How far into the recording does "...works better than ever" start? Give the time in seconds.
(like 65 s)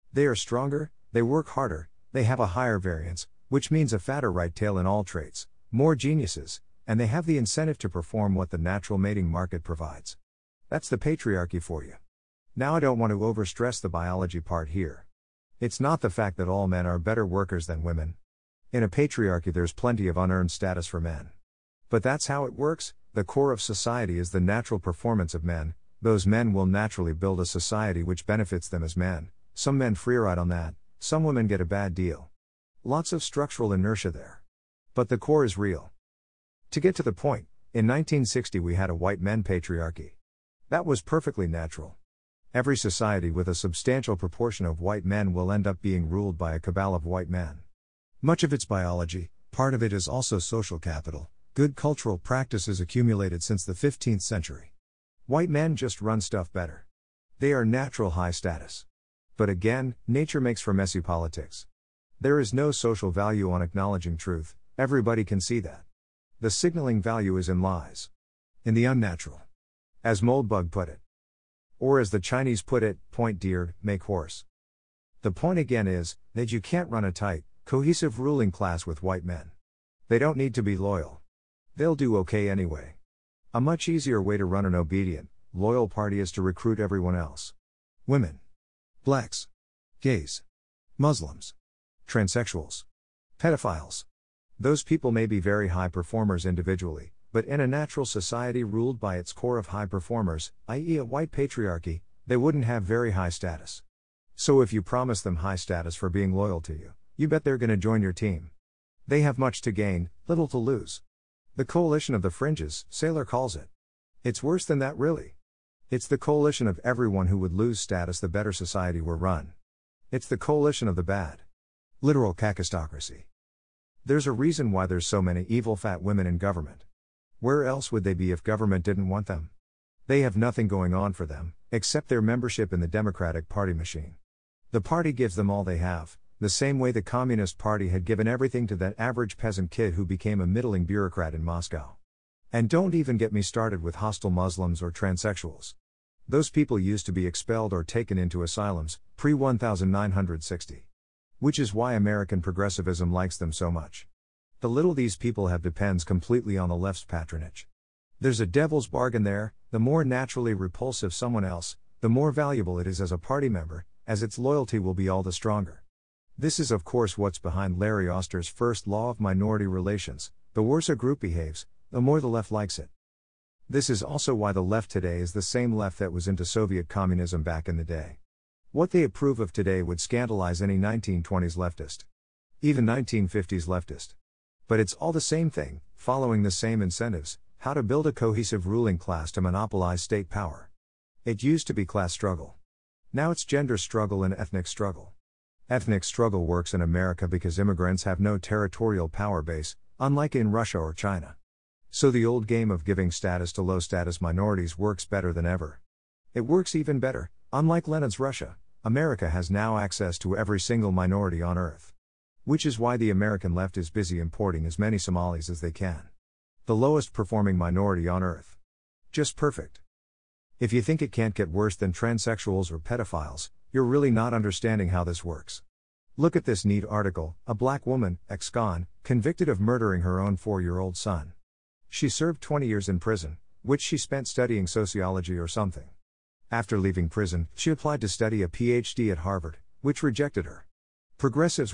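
204 s.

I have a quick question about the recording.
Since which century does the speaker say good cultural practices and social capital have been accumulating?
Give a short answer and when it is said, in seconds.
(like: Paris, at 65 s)
15th century, at 53 s.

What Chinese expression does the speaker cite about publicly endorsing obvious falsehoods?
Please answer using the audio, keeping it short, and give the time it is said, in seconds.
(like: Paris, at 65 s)
point deer, make horse, at 73 s.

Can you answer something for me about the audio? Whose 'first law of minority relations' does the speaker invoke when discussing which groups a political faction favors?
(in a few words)
Larry Auster.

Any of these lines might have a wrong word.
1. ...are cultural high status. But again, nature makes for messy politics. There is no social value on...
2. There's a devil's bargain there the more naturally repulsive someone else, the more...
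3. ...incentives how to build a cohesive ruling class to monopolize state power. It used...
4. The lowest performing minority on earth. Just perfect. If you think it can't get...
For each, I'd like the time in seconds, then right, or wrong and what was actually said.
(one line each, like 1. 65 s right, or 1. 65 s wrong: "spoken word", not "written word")
1. 57 s wrong: "natural", not "cultural"
2. 158 s right
3. 186 s right
4. 216 s right.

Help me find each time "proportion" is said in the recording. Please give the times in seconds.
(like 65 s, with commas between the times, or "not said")
44 s.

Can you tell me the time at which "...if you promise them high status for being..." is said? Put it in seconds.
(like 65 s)
104 s.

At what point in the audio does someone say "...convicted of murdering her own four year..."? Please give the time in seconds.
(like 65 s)
229 s.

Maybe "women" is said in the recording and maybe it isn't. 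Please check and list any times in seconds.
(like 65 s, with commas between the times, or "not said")
17 s, 31 s, 88 s, 126 s.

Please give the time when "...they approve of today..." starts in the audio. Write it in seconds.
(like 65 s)
178 s.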